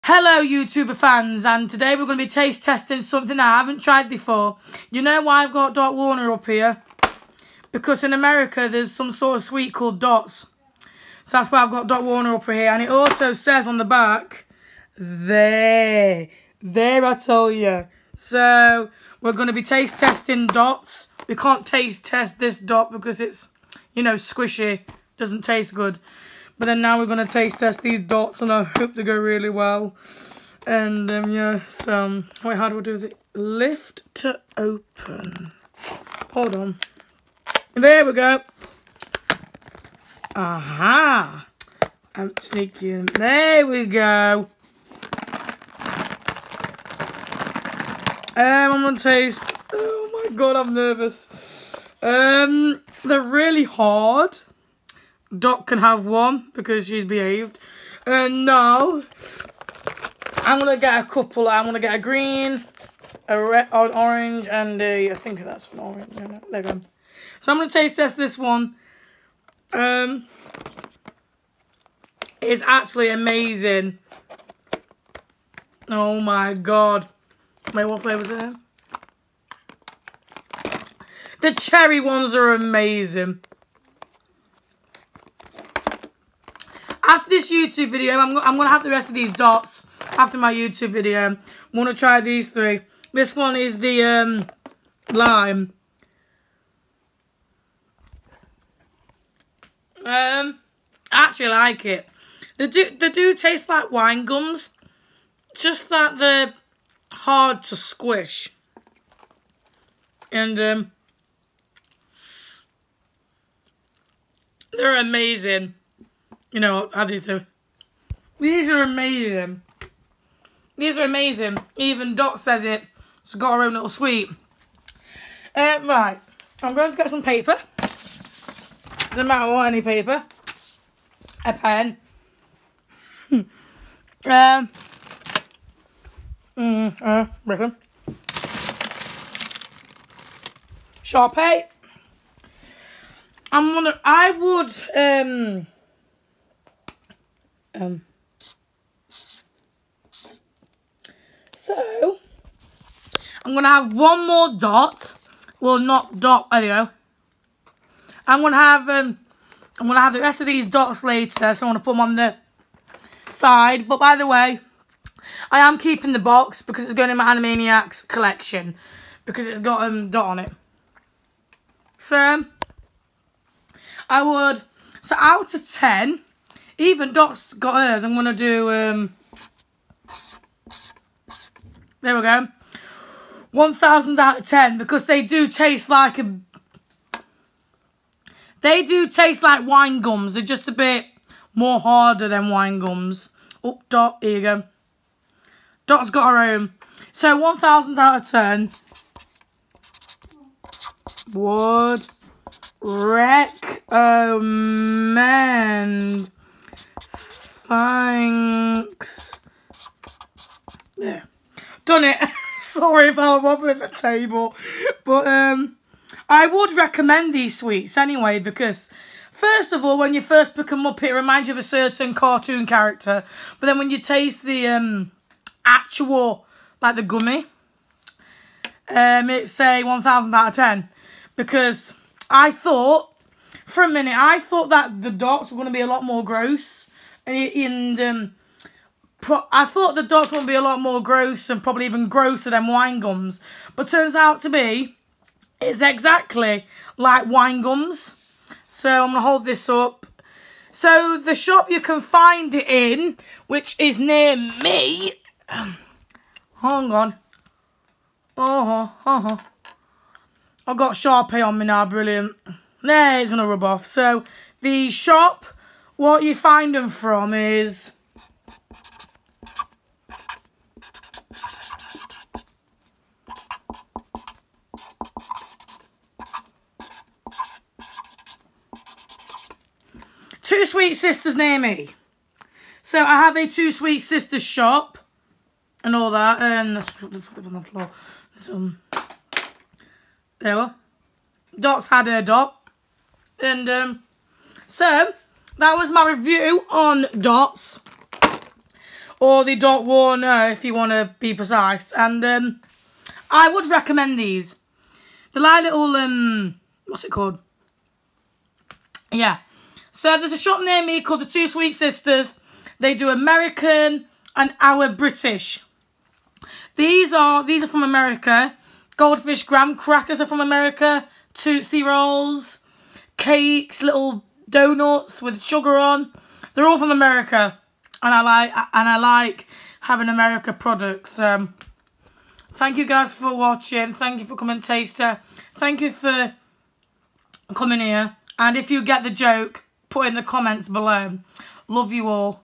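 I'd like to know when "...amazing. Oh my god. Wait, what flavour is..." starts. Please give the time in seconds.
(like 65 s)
73 s.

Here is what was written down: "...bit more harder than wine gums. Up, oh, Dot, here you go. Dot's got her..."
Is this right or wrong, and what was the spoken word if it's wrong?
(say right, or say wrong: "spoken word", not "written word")
right.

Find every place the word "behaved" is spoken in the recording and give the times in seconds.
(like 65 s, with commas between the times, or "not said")
57 s.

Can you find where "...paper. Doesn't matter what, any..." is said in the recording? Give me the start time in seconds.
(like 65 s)
127 s.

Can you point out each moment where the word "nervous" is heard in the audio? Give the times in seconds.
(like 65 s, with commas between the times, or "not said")
50 s.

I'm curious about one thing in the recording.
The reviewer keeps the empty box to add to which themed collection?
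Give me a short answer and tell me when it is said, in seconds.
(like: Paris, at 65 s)
Animaniacs collection, at 167 s.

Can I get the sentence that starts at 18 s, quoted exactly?
So we're going to be taste testing Dots.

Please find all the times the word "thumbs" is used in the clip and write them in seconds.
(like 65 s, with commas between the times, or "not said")
not said.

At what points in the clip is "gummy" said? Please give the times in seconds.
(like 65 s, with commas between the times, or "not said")
227 s.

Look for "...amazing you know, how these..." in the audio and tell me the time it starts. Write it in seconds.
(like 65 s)
114 s.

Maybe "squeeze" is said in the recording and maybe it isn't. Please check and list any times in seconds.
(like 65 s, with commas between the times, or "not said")
not said.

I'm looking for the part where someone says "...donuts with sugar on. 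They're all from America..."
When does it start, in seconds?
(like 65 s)
324 s.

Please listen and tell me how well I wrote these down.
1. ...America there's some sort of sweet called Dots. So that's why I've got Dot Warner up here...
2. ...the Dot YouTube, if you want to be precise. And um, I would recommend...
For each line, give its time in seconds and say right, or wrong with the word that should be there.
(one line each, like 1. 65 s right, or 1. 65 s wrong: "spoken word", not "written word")
1. 8 s right
2. 299 s wrong: "Warner", not "YouTube".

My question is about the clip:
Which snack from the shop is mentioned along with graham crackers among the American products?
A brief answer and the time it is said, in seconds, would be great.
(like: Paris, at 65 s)
Goldfish, at 318 s.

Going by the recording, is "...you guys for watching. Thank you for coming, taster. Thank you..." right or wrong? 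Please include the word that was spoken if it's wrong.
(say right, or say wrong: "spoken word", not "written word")
right.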